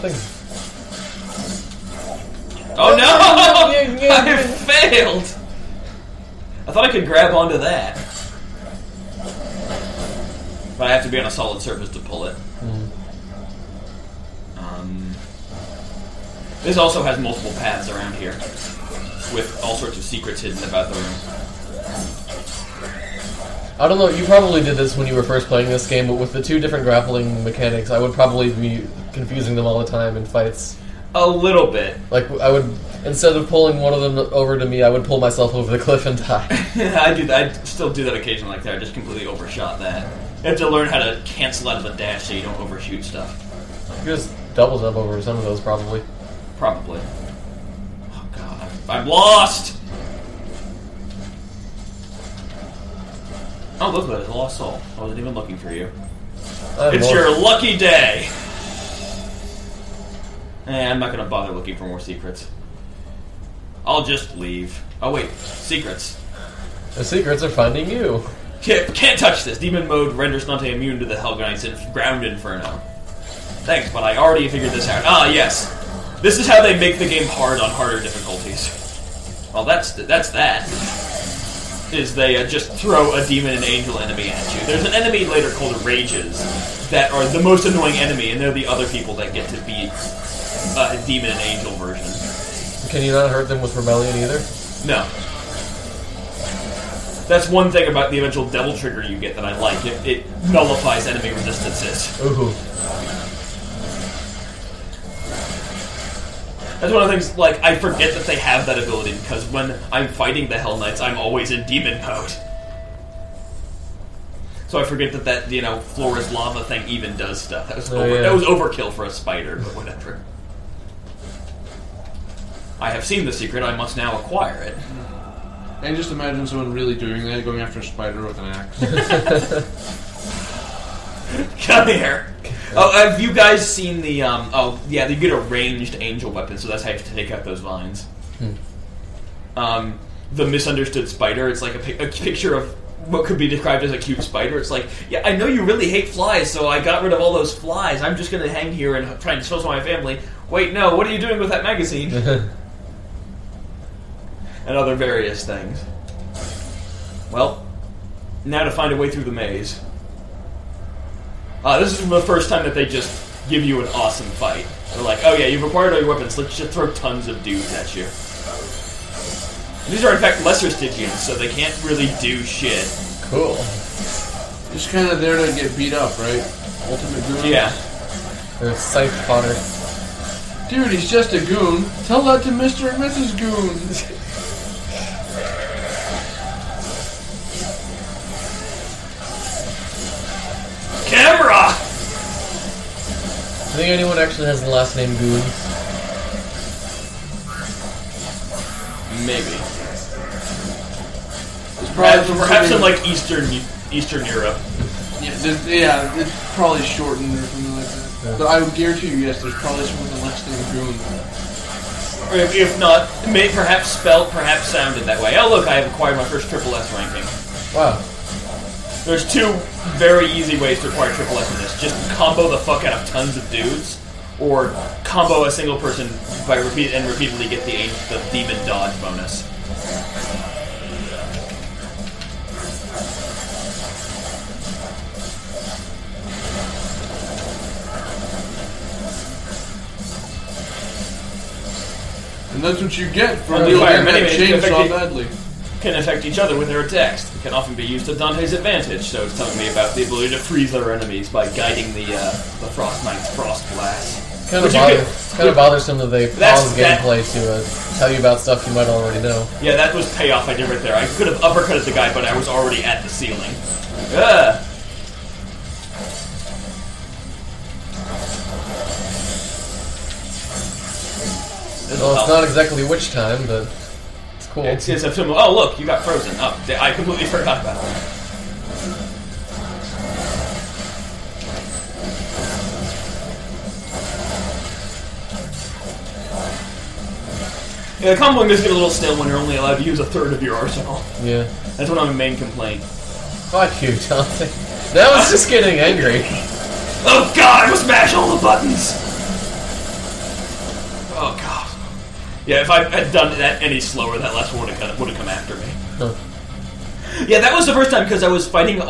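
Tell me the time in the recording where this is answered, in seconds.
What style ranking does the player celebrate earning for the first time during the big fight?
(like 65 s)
216 s.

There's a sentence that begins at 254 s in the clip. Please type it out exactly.
Kind of, bother, could, it's kind of bothersome that they pause gameplay to uh, tell you about stuff you might already know.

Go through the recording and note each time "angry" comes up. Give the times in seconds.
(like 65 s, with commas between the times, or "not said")
295 s.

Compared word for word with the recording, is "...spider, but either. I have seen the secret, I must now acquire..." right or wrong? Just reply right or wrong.
wrong.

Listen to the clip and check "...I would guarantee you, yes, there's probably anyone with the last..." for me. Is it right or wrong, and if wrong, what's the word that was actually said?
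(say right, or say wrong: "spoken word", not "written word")
wrong: "someone", not "anyone".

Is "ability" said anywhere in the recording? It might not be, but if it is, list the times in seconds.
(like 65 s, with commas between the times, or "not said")
108 s, 250 s.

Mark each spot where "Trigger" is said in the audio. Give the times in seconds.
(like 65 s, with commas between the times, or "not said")
98 s.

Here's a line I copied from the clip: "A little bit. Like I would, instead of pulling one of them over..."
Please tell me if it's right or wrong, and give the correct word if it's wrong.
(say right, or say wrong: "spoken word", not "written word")
right.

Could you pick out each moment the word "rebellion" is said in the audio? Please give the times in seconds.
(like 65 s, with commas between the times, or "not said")
93 s.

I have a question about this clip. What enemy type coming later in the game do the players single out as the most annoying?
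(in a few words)
Rages.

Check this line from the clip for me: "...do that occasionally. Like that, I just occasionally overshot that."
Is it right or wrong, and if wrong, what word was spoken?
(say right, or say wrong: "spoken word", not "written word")
wrong: "completely", not "occasionally".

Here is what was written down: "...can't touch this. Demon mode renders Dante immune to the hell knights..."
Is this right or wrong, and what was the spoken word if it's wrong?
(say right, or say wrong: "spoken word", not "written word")
right.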